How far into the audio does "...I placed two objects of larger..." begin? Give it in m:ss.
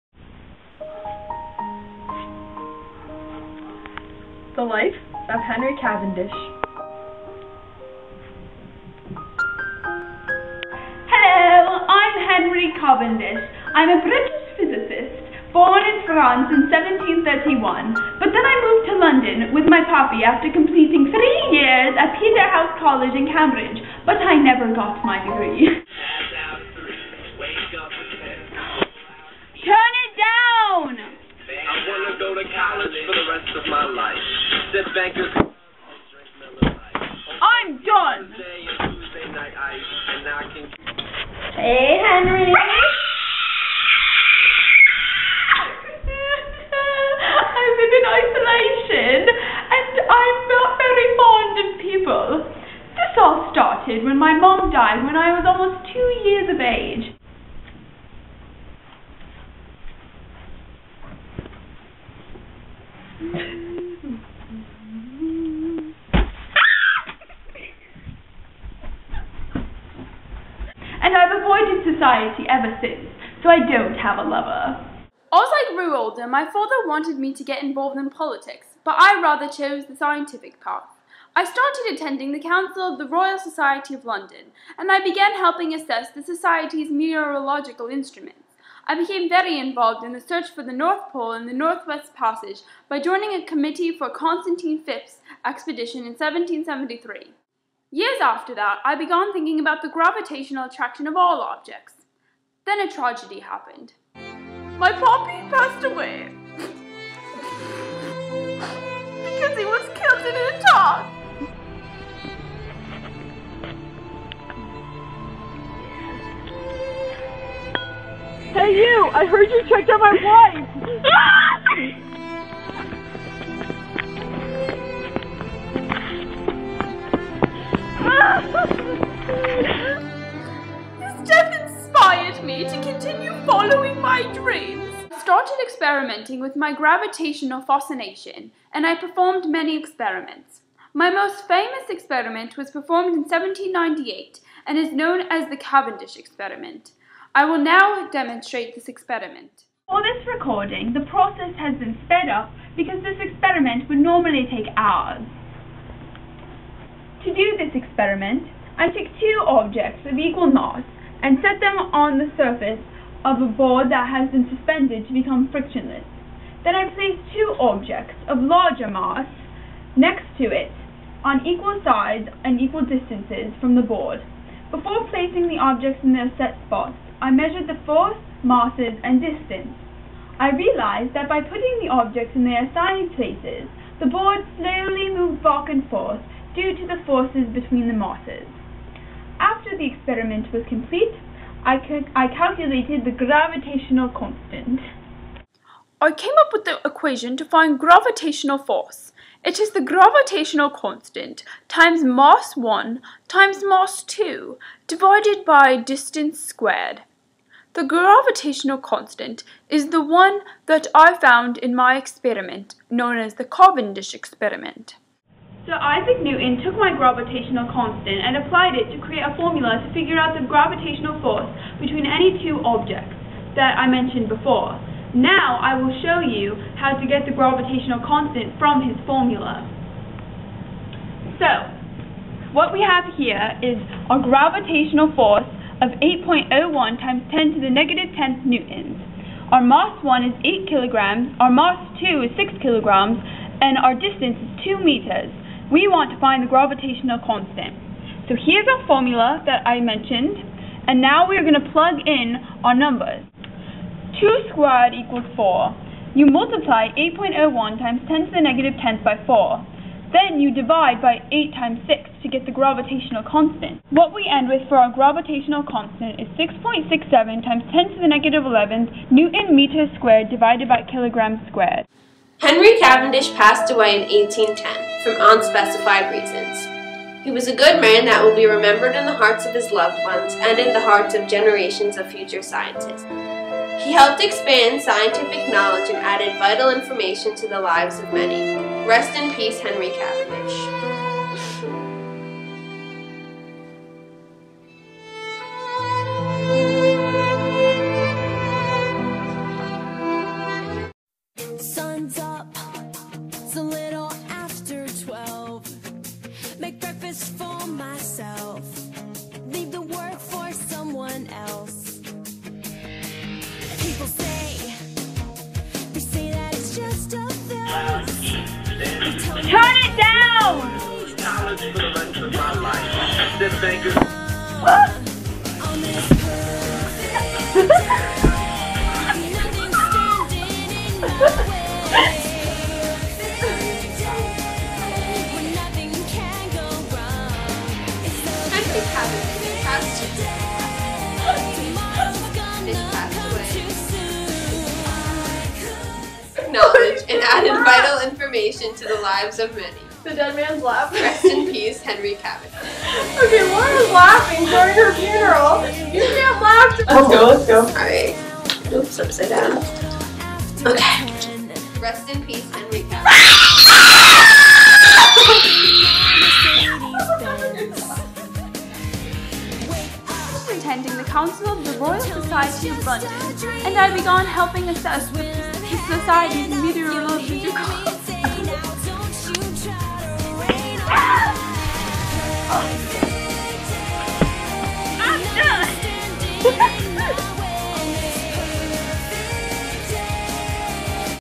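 2:46.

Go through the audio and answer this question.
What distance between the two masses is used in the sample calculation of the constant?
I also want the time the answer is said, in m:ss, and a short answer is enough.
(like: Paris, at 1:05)
2 meters, at 4:04.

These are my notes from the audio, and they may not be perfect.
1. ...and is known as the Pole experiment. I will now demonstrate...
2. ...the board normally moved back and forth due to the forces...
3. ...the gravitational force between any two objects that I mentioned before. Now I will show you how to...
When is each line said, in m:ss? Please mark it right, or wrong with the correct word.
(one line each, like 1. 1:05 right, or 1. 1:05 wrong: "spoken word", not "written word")
1. 2:24 wrong: "Cavendish", not "Pole"
2. 3:03 wrong: "slowly", not "normally"
3. 3:40 right.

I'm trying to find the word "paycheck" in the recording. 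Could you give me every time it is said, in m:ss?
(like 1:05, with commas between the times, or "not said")
not said.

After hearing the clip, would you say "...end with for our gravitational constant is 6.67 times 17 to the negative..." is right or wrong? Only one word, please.
wrong.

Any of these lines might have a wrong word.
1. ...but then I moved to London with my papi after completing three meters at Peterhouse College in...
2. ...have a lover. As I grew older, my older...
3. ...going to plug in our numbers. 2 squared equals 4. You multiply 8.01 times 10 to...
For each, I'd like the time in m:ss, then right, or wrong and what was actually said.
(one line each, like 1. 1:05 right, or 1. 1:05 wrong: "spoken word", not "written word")
1. 0:18 wrong: "years", not "meters"
2. 1:13 wrong: "father", not "older"
3. 4:11 right.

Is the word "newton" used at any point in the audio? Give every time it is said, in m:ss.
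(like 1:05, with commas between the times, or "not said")
3:36, 3:58, 4:29.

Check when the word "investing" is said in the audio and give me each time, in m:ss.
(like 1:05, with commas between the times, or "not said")
not said.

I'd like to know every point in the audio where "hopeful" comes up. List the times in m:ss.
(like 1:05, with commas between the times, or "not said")
not said.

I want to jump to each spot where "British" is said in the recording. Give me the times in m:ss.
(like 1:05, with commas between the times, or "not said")
0:14.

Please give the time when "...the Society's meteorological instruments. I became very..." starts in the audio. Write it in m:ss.
1:26.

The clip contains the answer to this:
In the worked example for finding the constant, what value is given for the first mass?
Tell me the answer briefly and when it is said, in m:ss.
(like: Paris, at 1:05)
8 kilograms, at 4:00.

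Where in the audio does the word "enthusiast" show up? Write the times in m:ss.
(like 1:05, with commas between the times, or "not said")
not said.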